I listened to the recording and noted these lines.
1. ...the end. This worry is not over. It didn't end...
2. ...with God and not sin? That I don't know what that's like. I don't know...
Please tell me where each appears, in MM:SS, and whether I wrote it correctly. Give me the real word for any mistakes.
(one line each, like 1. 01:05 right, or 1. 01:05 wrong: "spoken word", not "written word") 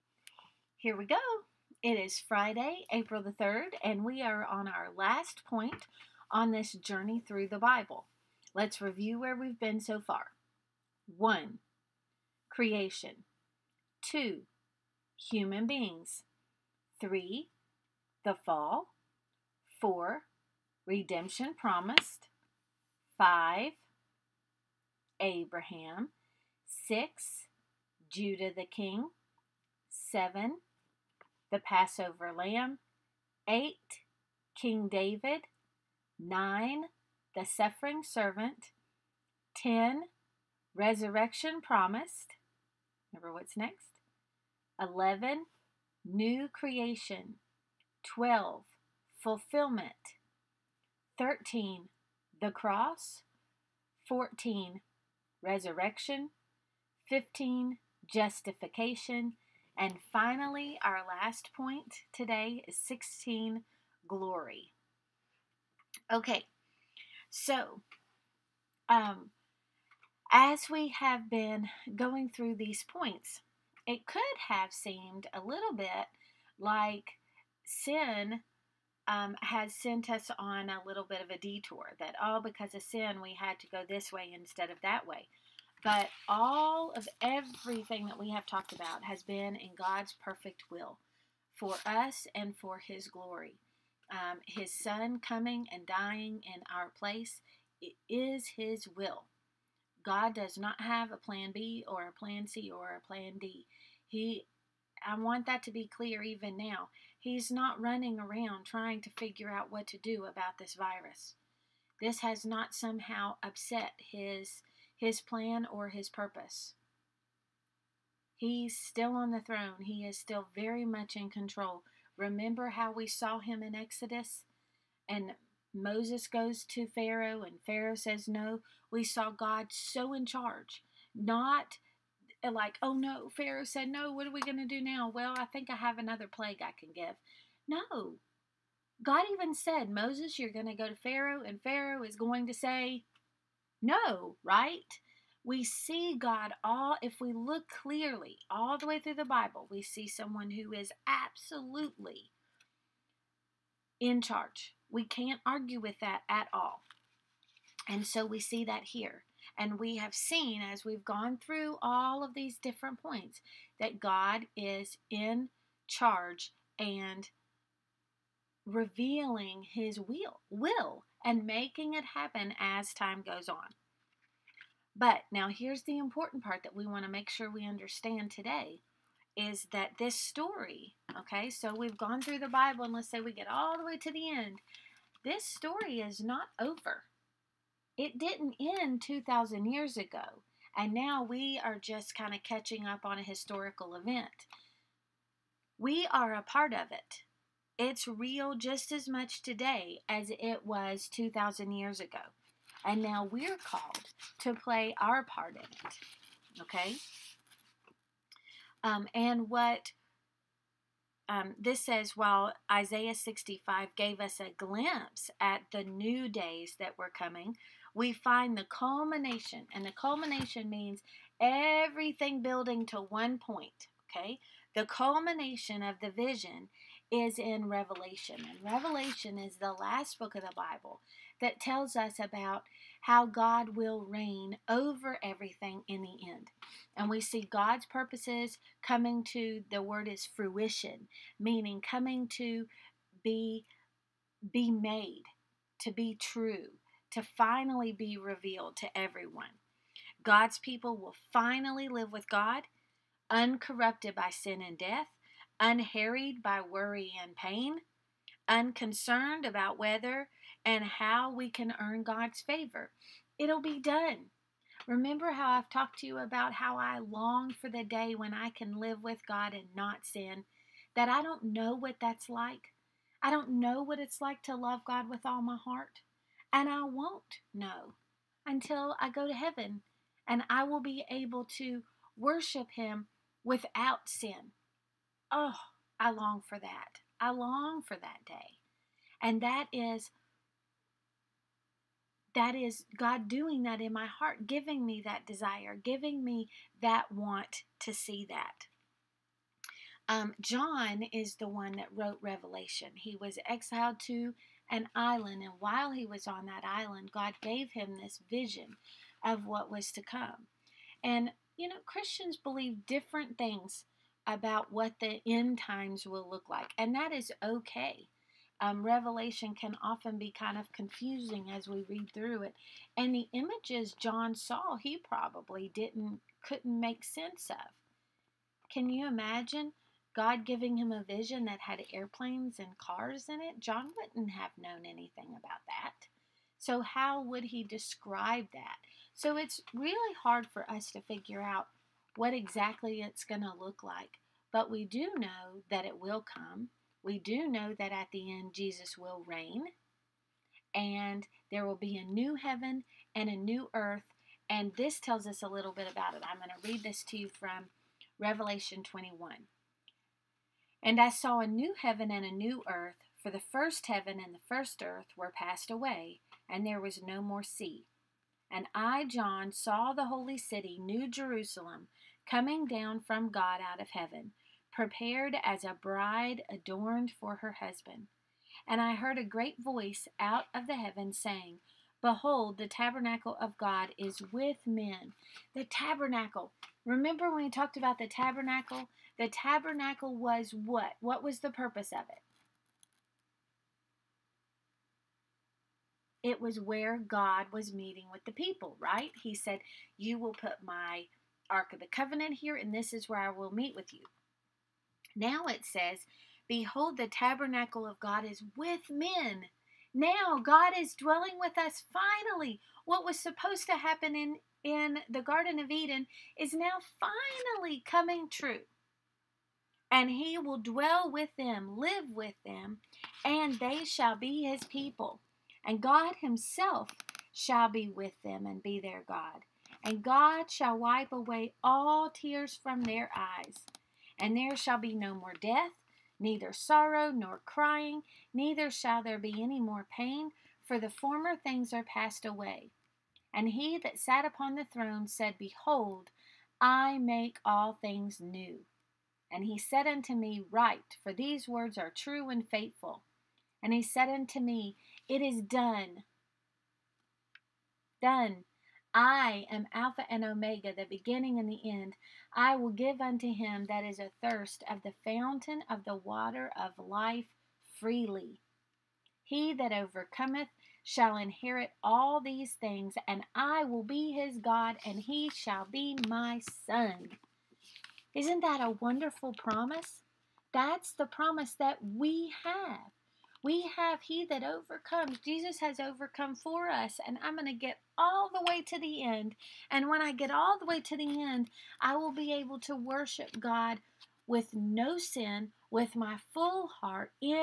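1. 03:04 wrong: "story", not "worry"
2. 04:29 right.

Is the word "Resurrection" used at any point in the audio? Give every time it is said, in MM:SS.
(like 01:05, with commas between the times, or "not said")
00:40, 00:55.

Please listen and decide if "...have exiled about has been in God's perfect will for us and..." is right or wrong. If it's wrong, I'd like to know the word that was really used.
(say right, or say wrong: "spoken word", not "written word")
wrong: "talked", not "exiled".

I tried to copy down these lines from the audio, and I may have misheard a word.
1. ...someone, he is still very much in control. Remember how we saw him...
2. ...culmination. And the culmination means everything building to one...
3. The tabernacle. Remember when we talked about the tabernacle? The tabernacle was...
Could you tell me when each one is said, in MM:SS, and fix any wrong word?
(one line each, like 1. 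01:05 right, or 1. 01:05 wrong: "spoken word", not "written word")
1. 01:59 wrong: "throne", not "someone"
2. 03:38 right
3. 06:25 right.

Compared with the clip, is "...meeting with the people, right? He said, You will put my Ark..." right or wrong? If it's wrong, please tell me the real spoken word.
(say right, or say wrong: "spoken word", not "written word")
right.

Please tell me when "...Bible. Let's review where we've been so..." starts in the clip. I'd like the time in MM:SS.
00:07.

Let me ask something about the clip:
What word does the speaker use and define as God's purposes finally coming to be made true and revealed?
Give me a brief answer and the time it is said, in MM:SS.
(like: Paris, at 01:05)
Fruition, at 04:00.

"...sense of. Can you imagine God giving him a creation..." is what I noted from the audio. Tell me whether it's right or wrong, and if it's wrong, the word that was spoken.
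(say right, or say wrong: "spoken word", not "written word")
wrong: "vision", not "creation".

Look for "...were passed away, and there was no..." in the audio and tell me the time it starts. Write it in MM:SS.
06:05.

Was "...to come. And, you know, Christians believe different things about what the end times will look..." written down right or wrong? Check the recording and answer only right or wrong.
right.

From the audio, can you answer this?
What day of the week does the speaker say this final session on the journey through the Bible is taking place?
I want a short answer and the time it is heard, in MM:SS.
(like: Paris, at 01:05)
Friday, at 00:02.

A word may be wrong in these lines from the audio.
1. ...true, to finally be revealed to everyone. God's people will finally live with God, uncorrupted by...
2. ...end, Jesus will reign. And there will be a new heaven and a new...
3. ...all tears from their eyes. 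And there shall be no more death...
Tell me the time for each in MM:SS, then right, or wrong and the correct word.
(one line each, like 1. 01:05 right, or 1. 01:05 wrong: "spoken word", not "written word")
1. 04:06 right
2. 05:48 right
3. 07:11 right.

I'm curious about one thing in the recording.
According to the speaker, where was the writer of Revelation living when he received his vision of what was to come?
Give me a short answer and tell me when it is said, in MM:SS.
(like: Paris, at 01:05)
An island, at 05:04.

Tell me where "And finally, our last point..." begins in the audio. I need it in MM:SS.
00:59.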